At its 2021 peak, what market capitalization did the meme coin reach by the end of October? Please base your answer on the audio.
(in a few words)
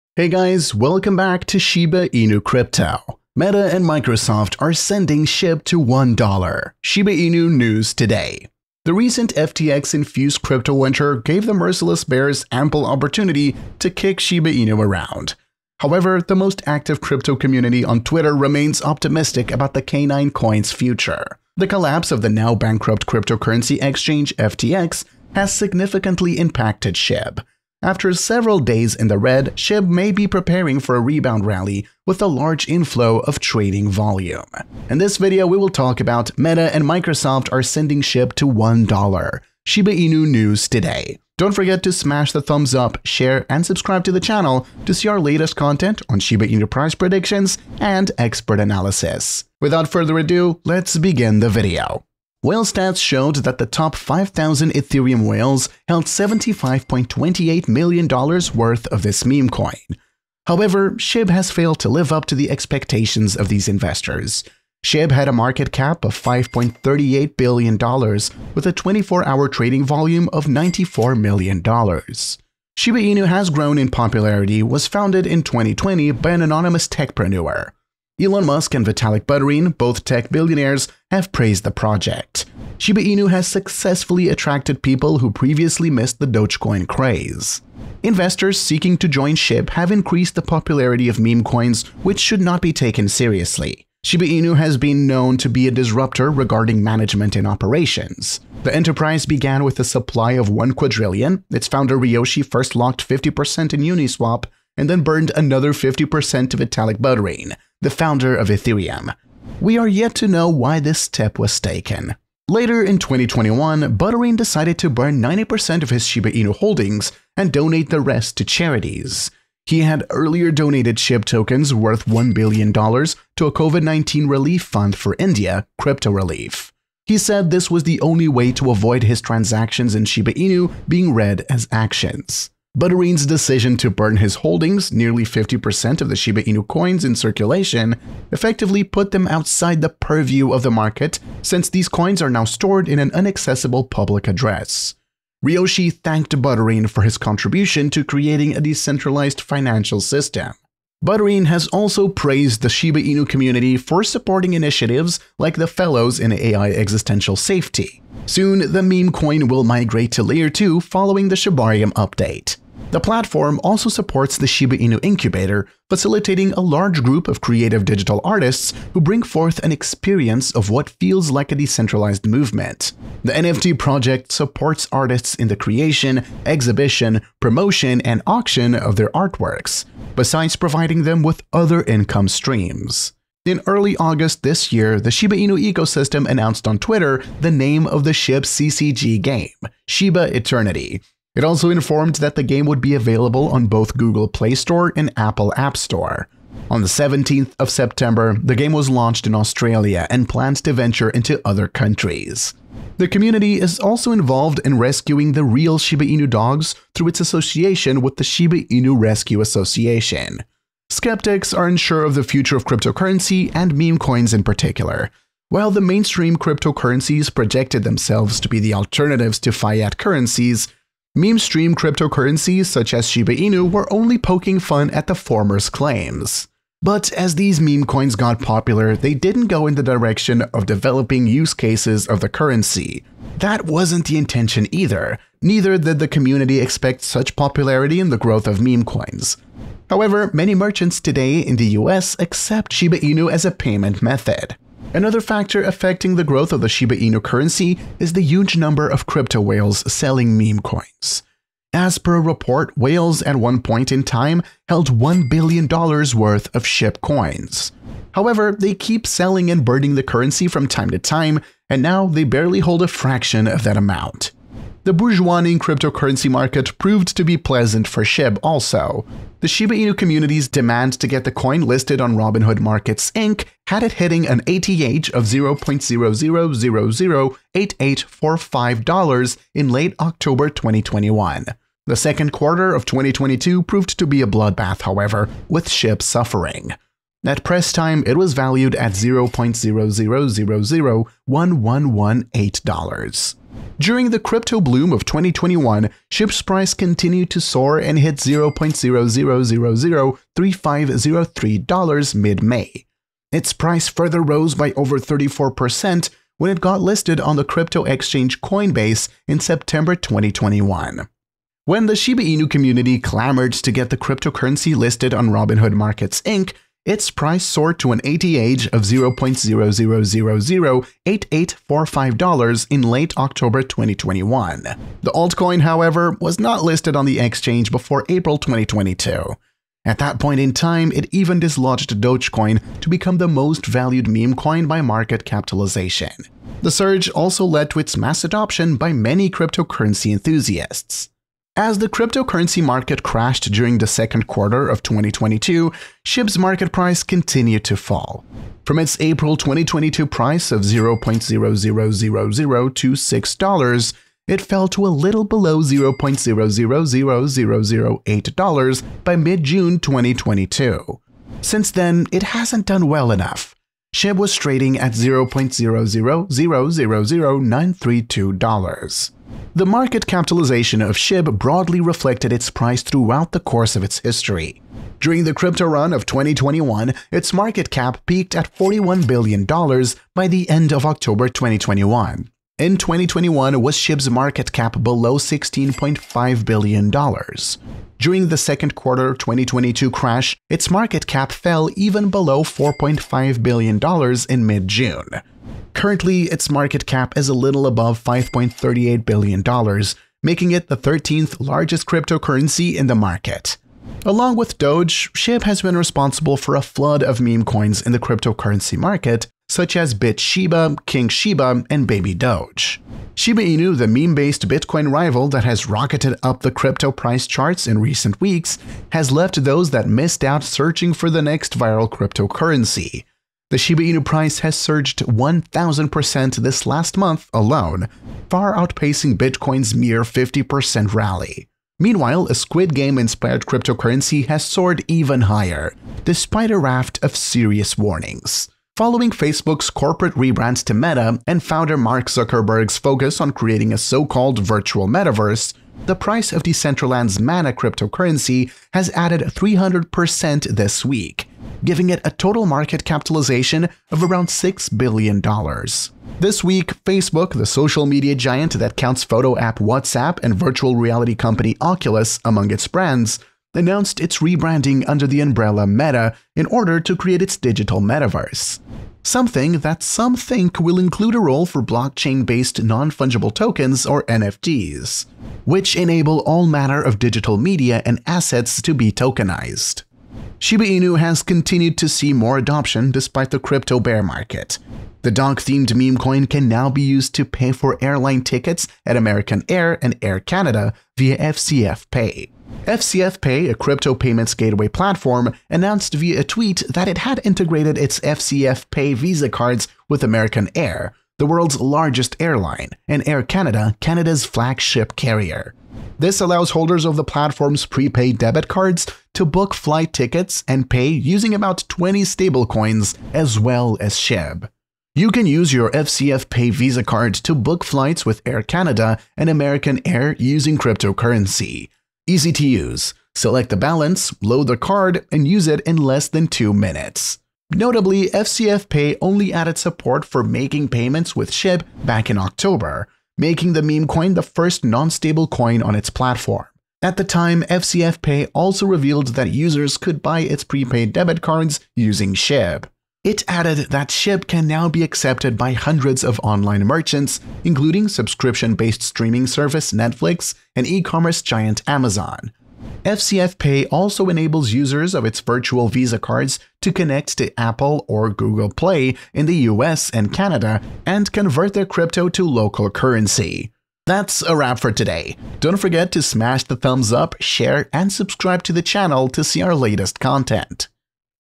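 $41 billion.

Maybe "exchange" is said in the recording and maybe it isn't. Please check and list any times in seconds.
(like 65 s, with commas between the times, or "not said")
23 s, 307 s, 327 s.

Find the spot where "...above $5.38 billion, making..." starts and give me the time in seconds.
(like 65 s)
397 s.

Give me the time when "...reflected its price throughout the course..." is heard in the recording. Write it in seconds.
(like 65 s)
371 s.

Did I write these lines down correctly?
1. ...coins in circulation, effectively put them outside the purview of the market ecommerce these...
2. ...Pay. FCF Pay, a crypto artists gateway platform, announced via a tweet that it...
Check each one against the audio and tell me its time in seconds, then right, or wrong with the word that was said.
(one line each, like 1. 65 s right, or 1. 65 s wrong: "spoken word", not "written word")
1. 136 s wrong: "since", not "ecommerce"
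2. 491 s wrong: "payments", not "artists".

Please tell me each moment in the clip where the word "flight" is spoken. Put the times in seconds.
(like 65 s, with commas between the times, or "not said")
509 s, 517 s.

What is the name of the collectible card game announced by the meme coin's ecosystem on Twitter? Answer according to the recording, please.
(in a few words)
Shiba Eternity.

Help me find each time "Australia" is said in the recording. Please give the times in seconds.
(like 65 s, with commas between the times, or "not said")
199 s.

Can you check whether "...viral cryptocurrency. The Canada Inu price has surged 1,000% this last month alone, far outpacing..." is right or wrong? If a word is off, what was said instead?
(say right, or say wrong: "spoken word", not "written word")
wrong: "Shiba", not "Canada".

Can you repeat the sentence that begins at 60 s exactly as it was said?
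However, SHIB has failed to live up to the expectations of these investors.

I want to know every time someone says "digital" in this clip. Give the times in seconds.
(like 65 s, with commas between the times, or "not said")
167 s, 467 s, 476 s.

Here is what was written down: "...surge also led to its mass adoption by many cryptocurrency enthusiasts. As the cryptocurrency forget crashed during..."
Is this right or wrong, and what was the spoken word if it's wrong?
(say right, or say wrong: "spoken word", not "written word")
wrong: "market", not "forget".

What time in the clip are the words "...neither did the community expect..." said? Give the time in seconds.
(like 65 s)
235 s.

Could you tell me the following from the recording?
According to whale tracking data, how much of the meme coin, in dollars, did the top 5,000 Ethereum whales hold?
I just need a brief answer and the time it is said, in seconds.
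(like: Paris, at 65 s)
$75.28 million, at 56 s.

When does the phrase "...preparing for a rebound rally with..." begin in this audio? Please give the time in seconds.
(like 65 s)
30 s.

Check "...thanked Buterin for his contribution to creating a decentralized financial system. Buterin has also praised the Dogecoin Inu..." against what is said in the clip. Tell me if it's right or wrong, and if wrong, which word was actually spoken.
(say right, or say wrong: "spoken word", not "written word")
wrong: "Shiba", not "Dogecoin".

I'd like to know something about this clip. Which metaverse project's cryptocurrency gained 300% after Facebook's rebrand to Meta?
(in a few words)
Decentraland.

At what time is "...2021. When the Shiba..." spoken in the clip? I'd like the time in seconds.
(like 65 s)
309 s.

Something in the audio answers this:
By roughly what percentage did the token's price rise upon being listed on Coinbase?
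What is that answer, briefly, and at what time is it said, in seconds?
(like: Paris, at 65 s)
over 34%, at 304 s.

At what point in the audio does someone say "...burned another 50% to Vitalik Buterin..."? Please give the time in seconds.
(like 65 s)
105 s.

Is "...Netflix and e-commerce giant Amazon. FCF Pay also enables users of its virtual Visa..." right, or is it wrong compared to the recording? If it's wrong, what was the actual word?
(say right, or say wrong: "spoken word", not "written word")
right.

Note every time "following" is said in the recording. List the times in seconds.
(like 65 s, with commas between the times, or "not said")
160 s, 438 s.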